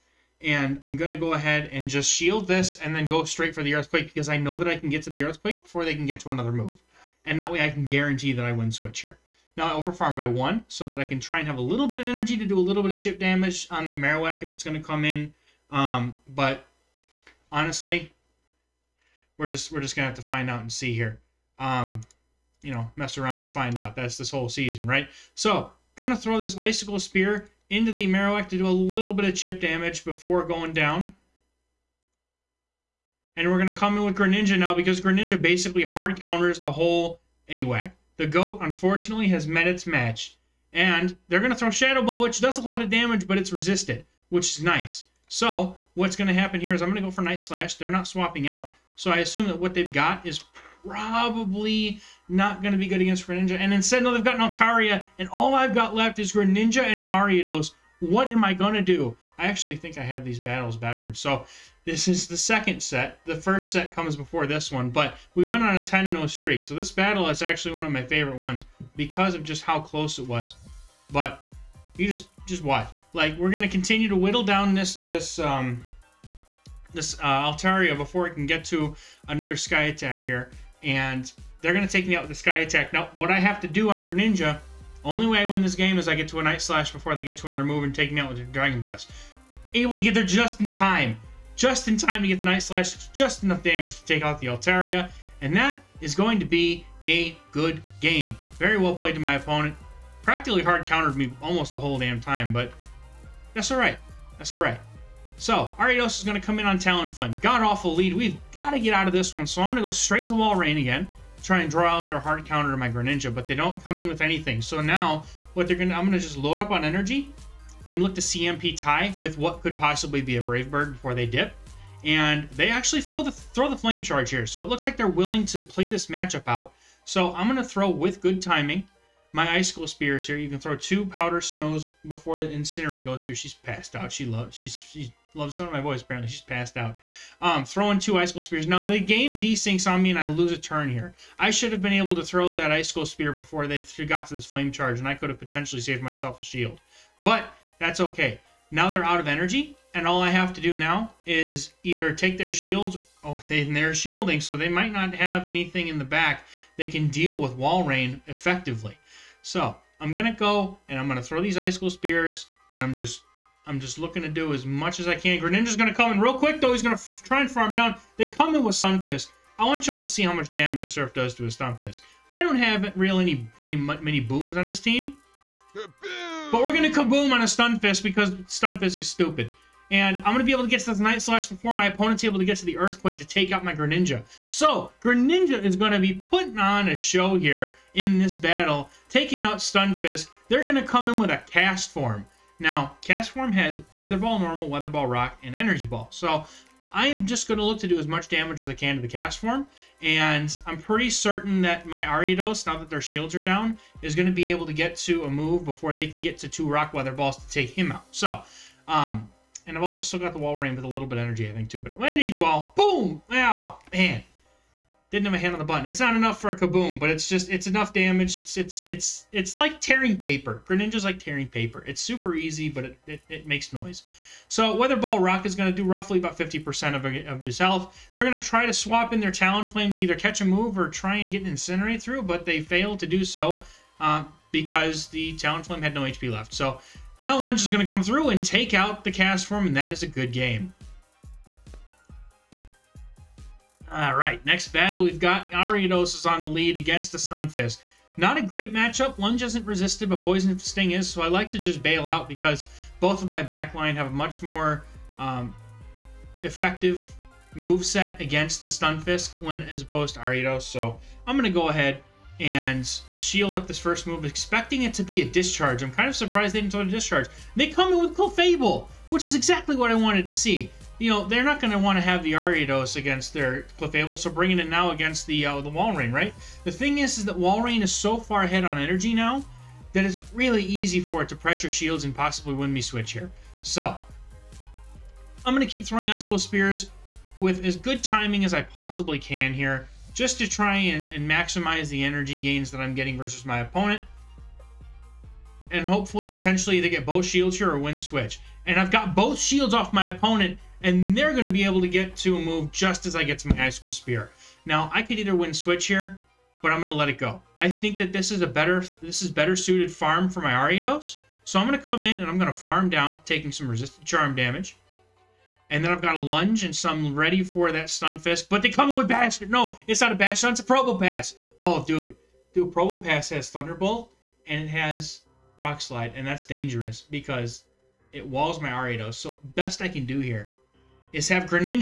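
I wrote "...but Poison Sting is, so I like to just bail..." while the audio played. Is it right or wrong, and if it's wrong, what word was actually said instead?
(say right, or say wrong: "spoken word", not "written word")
right.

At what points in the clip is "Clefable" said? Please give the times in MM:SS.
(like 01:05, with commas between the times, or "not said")
04:28, 04:33.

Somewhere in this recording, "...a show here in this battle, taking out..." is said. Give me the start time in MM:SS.
03:06.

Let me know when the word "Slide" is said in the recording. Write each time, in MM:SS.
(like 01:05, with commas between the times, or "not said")
05:25.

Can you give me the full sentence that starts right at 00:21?
Um, you know, mess around and find out.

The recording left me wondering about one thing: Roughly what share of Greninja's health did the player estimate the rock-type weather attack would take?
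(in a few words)
50%.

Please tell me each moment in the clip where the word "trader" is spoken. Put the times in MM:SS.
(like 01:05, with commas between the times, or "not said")
not said.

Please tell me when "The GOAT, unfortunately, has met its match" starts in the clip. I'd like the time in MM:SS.
00:38.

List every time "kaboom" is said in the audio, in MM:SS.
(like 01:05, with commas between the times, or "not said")
02:57, 03:36.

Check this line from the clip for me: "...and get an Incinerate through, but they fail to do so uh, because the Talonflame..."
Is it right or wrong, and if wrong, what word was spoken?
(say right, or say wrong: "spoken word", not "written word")
right.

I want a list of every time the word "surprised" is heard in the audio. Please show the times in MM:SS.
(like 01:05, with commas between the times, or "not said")
04:26.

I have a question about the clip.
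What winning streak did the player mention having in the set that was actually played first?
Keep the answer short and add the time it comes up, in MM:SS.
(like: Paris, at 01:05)
10-0, at 01:05.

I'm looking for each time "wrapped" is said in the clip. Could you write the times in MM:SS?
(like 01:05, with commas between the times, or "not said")
not said.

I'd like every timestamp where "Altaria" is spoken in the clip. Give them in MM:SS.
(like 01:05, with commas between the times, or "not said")
00:54, 01:17, 01:34.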